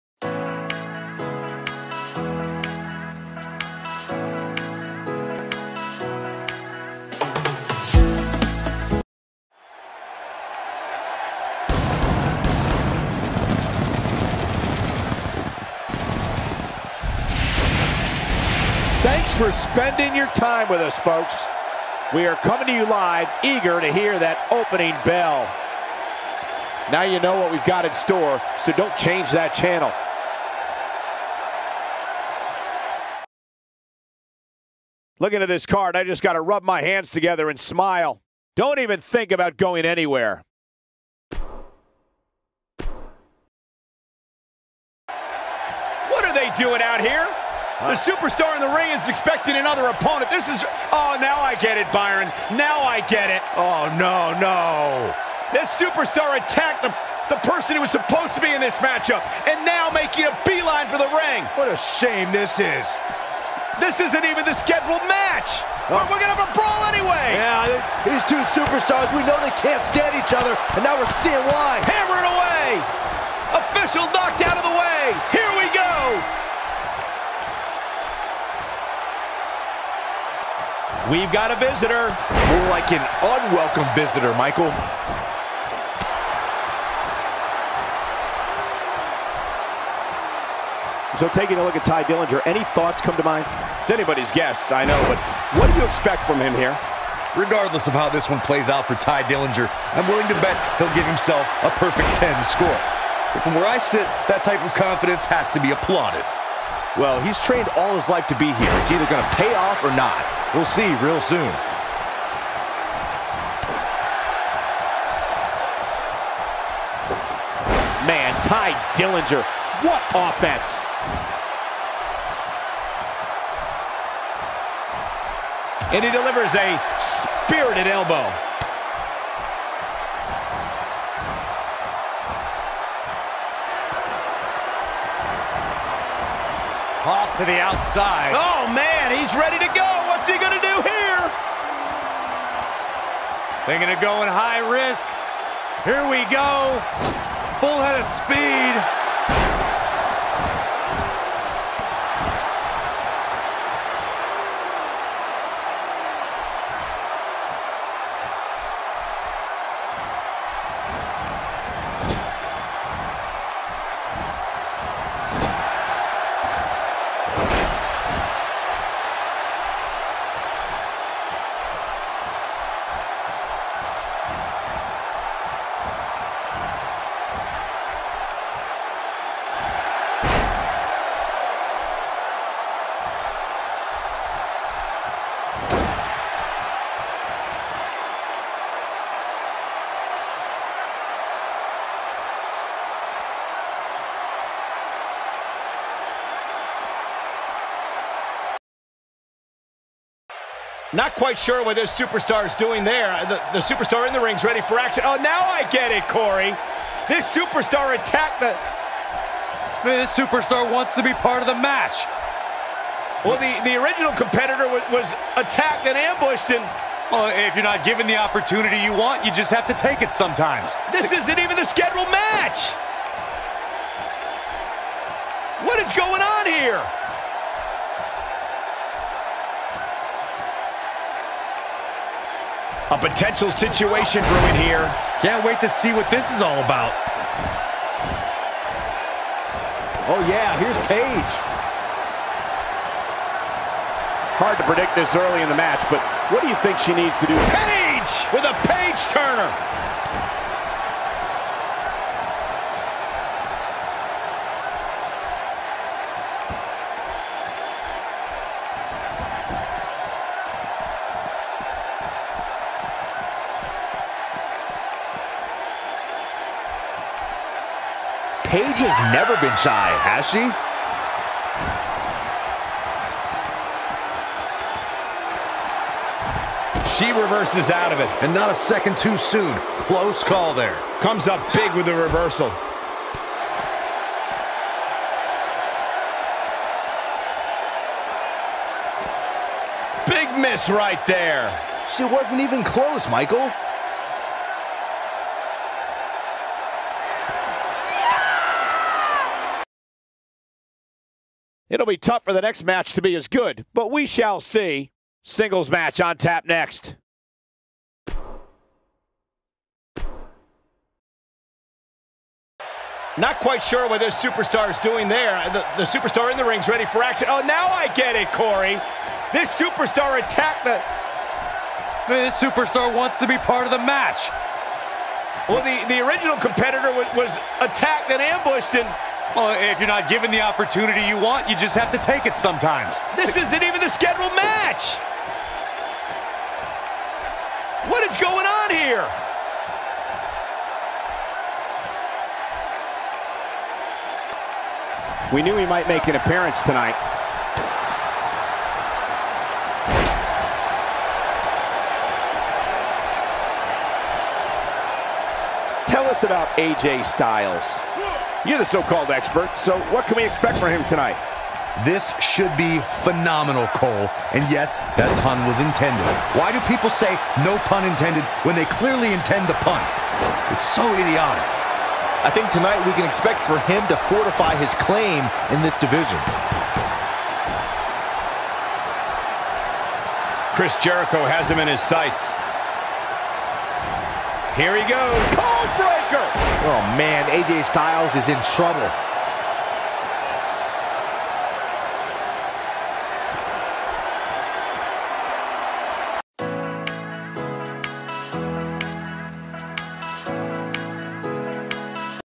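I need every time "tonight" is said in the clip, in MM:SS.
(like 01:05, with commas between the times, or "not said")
05:46, 06:00, 06:12.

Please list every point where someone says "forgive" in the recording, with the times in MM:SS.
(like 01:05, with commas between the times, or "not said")
not said.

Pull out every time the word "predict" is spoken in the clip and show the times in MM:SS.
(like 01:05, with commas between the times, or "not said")
04:04.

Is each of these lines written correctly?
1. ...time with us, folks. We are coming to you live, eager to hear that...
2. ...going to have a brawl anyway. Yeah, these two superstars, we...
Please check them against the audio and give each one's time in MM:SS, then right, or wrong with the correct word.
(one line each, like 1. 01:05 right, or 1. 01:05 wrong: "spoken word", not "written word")
1. 00:20 right
2. 01:06 right.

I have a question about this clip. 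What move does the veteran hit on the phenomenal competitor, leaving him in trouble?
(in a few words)
Code Breaker.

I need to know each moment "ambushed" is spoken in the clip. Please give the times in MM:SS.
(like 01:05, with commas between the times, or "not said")
03:35, 05:28.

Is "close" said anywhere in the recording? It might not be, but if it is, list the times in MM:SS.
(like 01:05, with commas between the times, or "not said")
04:39, 04:52.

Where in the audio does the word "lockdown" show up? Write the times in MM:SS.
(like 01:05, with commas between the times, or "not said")
not said.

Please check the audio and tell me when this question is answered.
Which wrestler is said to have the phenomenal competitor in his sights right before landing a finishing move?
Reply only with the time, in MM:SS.
06:20.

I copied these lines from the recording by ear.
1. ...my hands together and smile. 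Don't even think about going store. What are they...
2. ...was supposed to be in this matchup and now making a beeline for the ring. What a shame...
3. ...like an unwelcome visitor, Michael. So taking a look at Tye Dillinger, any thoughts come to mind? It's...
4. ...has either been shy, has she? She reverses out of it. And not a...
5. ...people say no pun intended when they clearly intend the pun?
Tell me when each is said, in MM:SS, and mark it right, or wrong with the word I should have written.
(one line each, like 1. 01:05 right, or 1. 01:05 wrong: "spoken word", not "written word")
1. 00:36 wrong: "anywhere", not "store"
2. 00:57 right
3. 01:22 right
4. 04:28 wrong: "never", not "either"
5. 06:06 right.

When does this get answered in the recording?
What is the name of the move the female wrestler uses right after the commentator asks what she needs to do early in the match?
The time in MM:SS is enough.
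04:08.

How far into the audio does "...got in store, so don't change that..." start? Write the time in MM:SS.
00:27.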